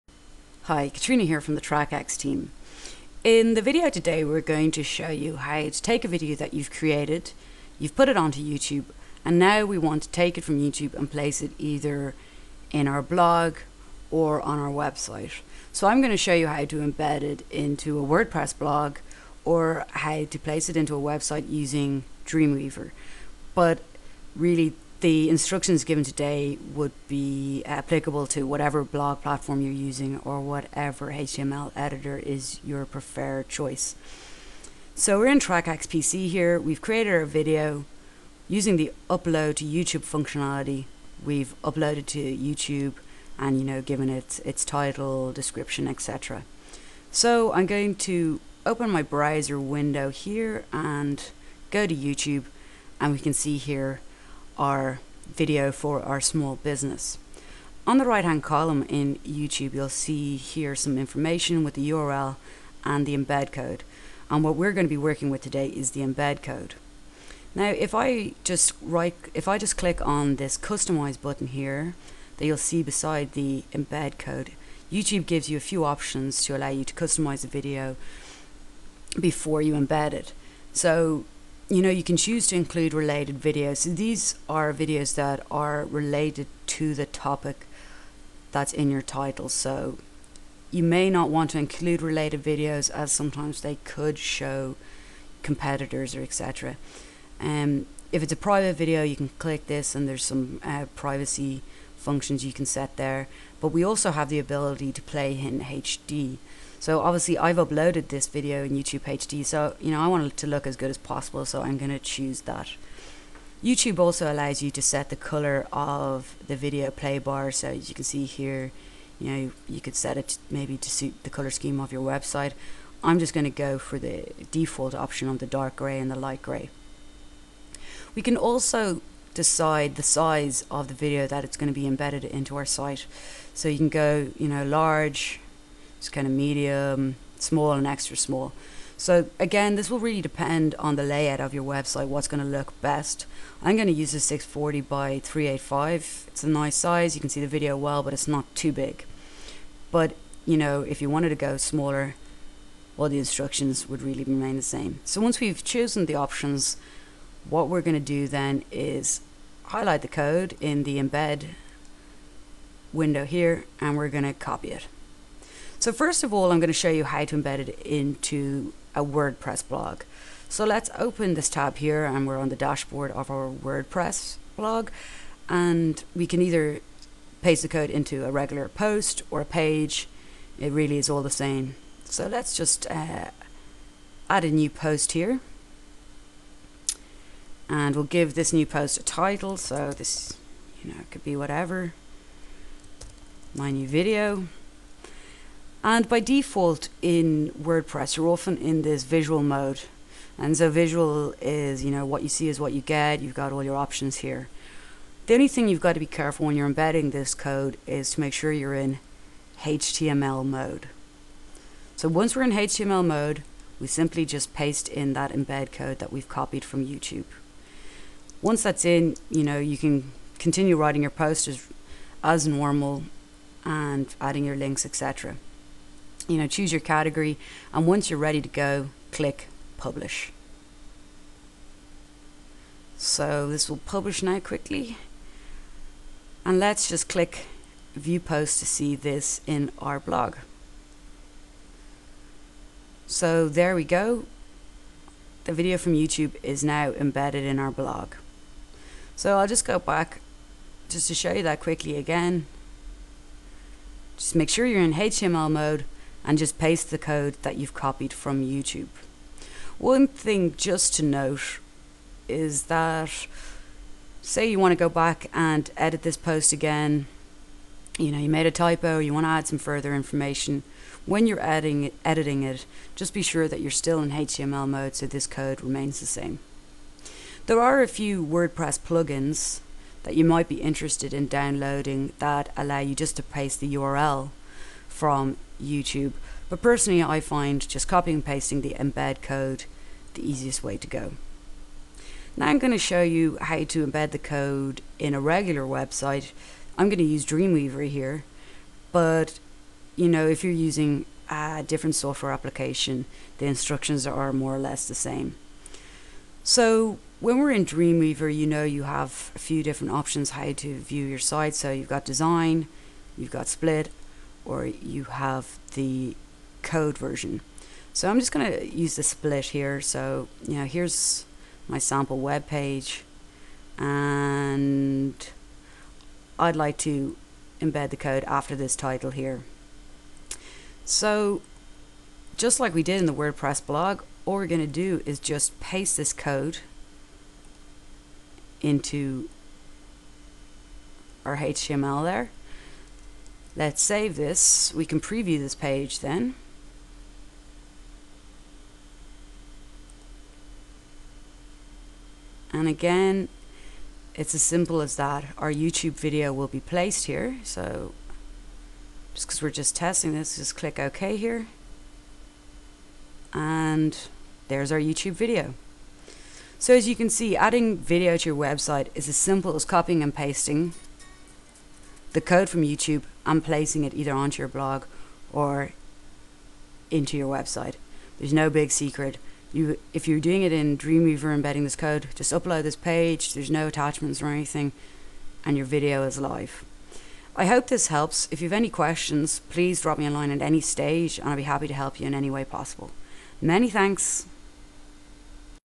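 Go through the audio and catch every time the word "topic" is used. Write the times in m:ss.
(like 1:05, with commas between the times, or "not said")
1:27.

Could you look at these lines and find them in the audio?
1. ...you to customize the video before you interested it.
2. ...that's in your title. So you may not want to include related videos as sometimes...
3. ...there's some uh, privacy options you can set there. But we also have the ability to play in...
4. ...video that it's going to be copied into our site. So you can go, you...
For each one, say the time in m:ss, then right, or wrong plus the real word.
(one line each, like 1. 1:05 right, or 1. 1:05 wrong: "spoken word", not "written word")
1. 1:16 wrong: "embed", not "interested"
2. 1:28 right
3. 1:40 wrong: "functions", not "options"
4. 2:10 wrong: "embedded", not "copied".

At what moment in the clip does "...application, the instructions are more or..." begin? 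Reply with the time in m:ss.
5:02.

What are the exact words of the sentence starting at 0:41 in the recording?
We've uploaded to YouTube and you know given it its title, description, etc.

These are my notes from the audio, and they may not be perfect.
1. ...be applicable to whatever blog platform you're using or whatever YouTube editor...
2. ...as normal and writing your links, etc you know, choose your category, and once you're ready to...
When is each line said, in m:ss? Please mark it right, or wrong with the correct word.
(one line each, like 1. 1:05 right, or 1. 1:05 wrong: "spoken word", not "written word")
1. 0:27 wrong: "HTML", not "YouTube"
2. 3:42 wrong: "adding", not "writing".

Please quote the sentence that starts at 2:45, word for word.
So first of all, I'm going to show you how to embed it into a WordPress blog.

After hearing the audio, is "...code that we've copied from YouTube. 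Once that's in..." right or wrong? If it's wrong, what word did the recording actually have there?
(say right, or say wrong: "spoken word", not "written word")
right.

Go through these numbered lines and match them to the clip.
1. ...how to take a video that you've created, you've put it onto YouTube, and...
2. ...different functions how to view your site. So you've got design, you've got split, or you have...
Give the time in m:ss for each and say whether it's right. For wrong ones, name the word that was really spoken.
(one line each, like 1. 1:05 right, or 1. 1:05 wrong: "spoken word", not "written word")
1. 0:05 right
2. 5:09 wrong: "options", not "functions".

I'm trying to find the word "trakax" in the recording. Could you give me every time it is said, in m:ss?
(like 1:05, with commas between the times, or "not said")
0:01, 0:35.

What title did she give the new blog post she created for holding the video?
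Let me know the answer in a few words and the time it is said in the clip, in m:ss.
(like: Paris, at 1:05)
my new video, at 3:13.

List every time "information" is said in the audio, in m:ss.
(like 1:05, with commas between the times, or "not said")
1:00, 4:29.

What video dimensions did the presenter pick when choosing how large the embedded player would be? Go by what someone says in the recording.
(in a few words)
640 by 385.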